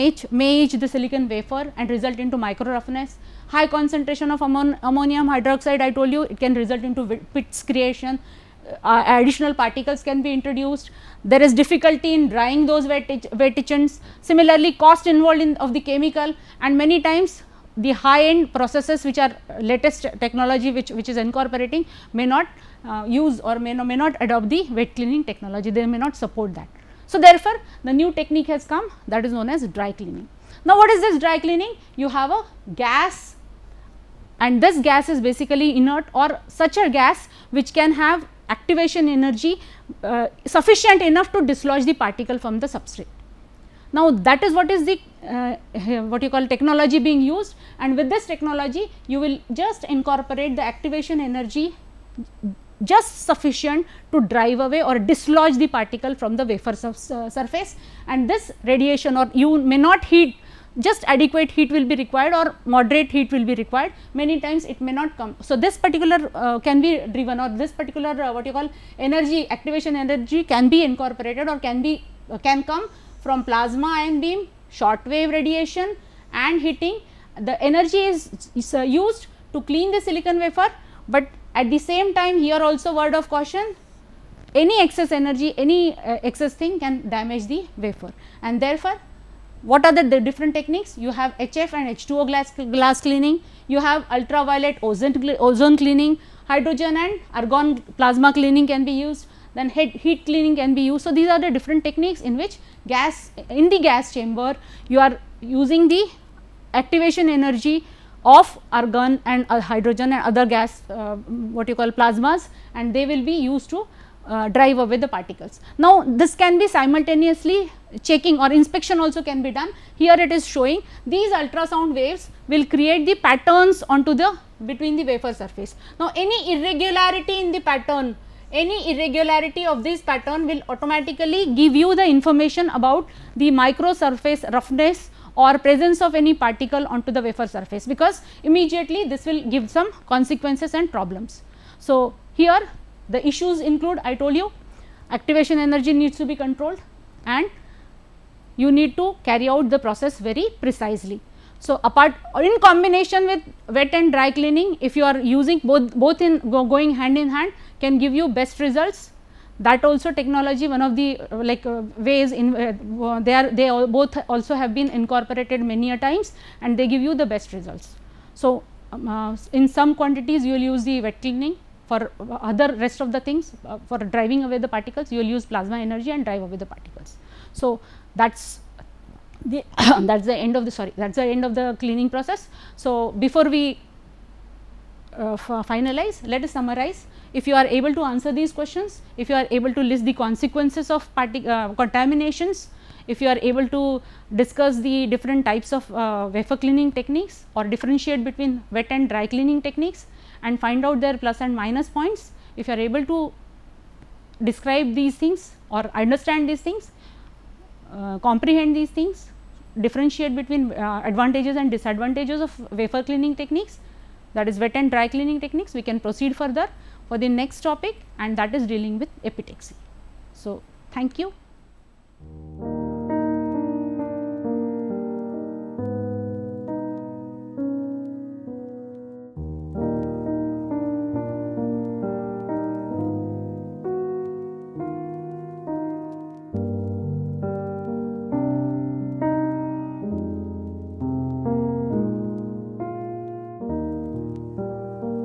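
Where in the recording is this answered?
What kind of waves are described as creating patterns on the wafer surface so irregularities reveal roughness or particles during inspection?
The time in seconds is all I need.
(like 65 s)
121 s.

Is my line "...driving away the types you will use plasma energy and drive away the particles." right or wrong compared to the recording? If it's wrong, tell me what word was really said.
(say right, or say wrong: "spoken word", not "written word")
wrong: "particles", not "types".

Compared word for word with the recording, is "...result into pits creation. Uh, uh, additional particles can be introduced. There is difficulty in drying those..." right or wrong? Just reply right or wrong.
right.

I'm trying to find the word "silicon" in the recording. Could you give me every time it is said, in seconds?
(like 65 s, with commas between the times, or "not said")
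0 s, 80 s.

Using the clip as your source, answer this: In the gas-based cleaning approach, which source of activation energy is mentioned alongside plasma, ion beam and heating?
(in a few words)
Short wave radiation.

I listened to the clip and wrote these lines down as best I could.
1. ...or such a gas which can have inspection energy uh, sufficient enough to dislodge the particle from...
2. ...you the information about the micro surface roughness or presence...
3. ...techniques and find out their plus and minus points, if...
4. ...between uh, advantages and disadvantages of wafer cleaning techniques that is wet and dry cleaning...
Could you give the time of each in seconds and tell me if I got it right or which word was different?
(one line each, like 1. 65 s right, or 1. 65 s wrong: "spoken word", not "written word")
1. 36 s wrong: "activation", not "inspection"
2. 131 s right
3. 199 s right
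4. 210 s right.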